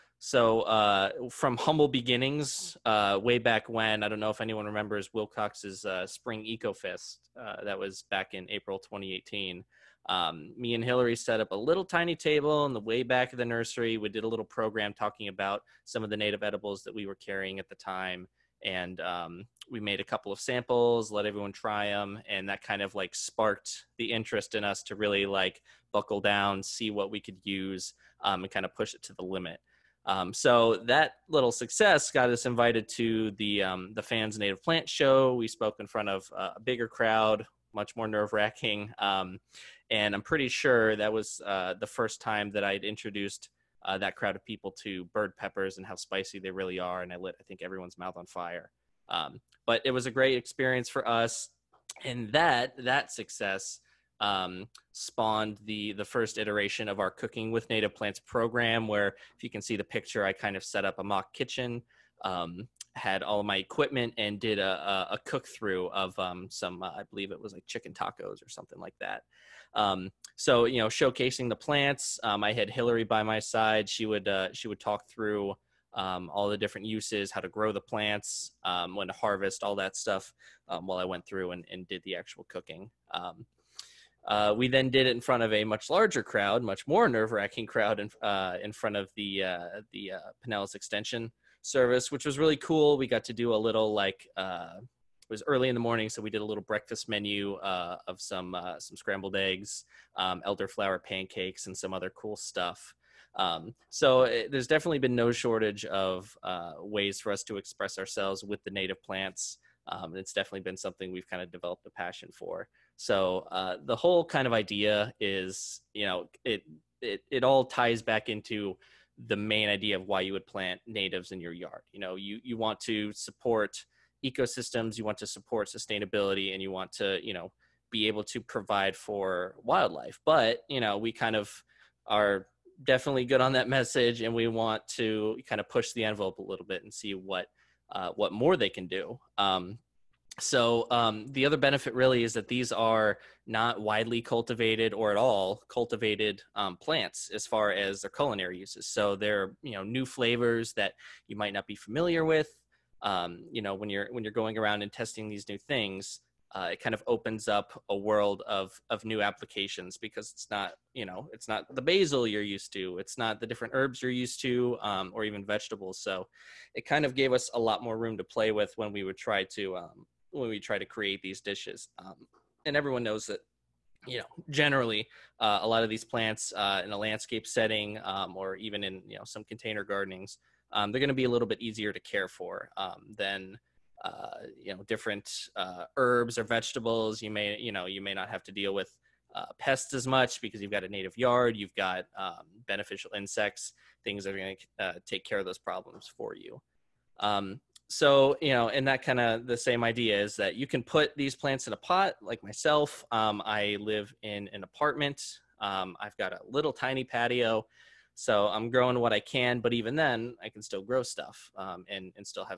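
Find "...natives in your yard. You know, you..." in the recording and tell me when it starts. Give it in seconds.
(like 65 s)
120 s.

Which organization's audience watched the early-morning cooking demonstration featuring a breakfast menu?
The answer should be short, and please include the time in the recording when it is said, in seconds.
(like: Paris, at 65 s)
Pinellas Extension service, at 90 s.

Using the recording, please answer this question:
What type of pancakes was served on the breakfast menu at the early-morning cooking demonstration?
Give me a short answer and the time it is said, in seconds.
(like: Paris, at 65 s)
elderflower pancakes, at 100 s.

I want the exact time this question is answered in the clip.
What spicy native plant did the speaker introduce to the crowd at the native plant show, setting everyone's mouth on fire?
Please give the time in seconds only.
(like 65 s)
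45 s.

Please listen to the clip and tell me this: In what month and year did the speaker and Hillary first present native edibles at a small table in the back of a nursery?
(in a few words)
April 2018.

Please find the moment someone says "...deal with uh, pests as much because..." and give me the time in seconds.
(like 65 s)
188 s.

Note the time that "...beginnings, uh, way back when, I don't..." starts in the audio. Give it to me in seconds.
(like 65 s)
1 s.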